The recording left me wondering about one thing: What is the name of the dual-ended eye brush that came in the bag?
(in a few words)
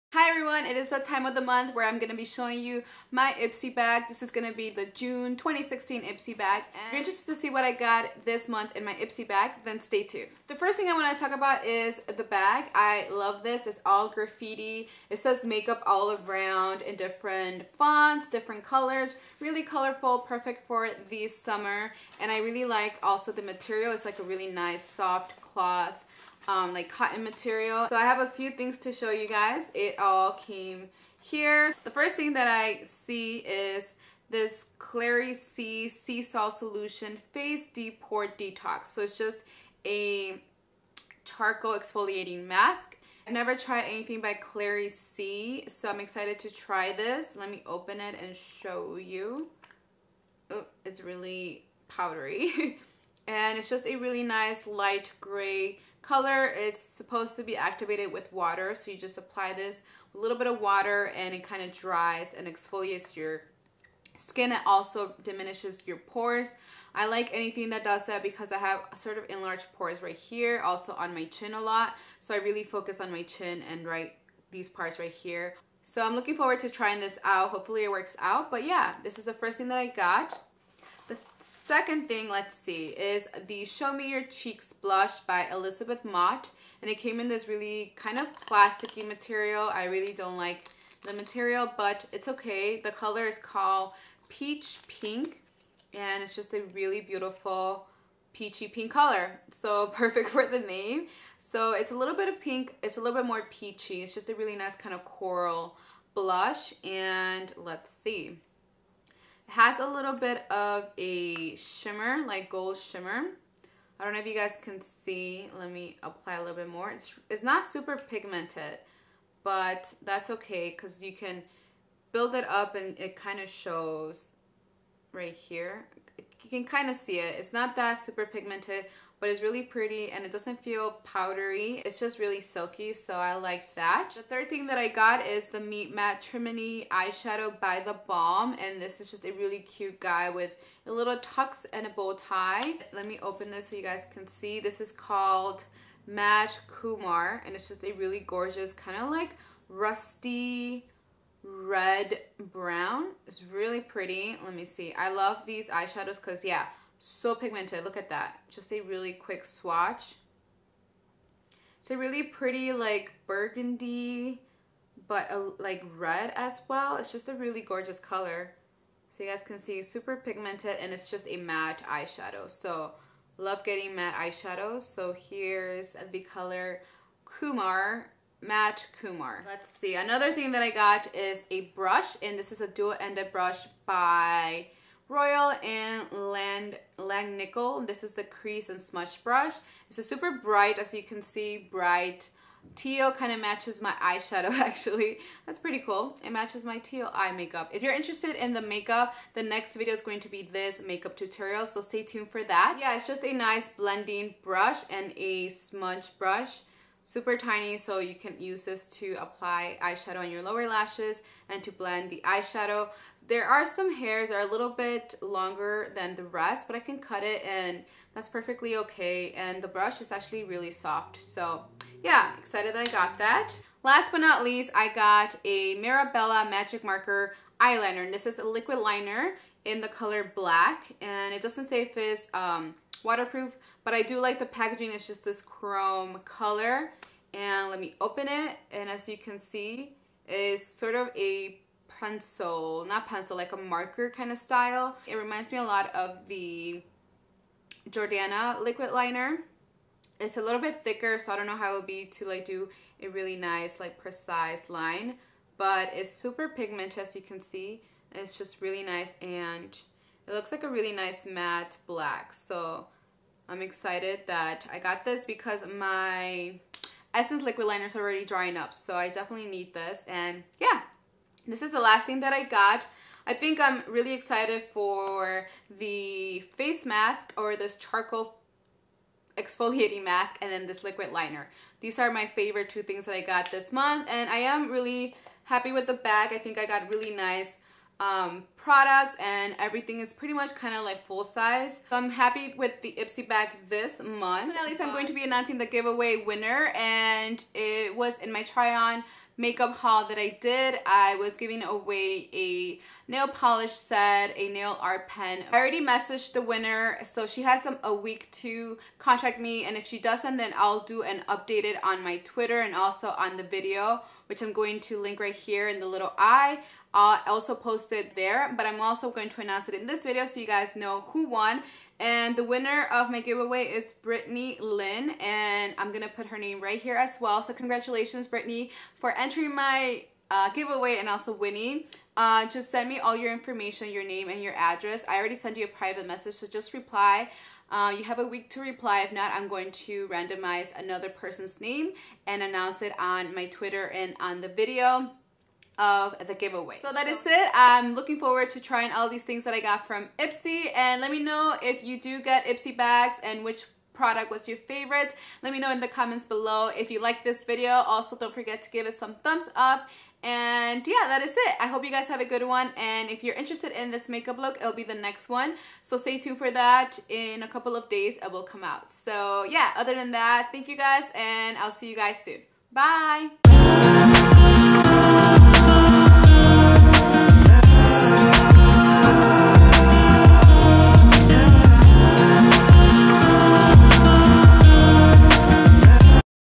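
crease and smudge brush.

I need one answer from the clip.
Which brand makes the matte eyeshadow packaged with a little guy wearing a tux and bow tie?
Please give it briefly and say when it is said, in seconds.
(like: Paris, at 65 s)
The Balm, at 137 s.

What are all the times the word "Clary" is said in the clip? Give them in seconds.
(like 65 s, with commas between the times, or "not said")
34 s, 44 s.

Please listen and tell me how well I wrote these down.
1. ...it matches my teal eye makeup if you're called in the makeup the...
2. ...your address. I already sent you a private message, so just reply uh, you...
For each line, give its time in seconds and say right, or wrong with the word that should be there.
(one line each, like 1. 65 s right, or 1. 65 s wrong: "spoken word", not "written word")
1. 196 s wrong: "interested", not "called"
2. 334 s right.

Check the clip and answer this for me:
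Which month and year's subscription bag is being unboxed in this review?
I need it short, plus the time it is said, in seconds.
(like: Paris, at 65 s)
June 2016, at 4 s.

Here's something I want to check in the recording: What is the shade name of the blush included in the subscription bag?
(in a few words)
Peach Pink.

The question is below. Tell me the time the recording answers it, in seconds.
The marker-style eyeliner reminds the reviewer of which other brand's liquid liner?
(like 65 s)
247 s.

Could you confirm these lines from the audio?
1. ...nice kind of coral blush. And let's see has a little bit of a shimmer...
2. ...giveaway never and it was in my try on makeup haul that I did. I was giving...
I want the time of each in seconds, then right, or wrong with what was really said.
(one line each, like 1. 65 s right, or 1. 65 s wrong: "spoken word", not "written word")
1. 104 s right
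2. 295 s wrong: "winner", not "never".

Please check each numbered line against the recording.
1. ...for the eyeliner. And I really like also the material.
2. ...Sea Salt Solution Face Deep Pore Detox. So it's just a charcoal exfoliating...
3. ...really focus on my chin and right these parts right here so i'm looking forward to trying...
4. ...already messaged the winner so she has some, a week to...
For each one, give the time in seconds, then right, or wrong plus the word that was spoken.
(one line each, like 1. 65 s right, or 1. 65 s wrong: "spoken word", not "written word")
1. 20 s wrong: "summer", not "eyeliner"
2. 35 s right
3. 72 s right
4. 305 s right.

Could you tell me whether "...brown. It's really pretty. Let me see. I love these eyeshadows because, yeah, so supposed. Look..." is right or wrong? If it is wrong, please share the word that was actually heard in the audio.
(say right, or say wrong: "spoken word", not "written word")
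wrong: "pigmented", not "supposed".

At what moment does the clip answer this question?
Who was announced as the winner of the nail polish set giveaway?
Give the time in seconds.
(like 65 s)
323 s.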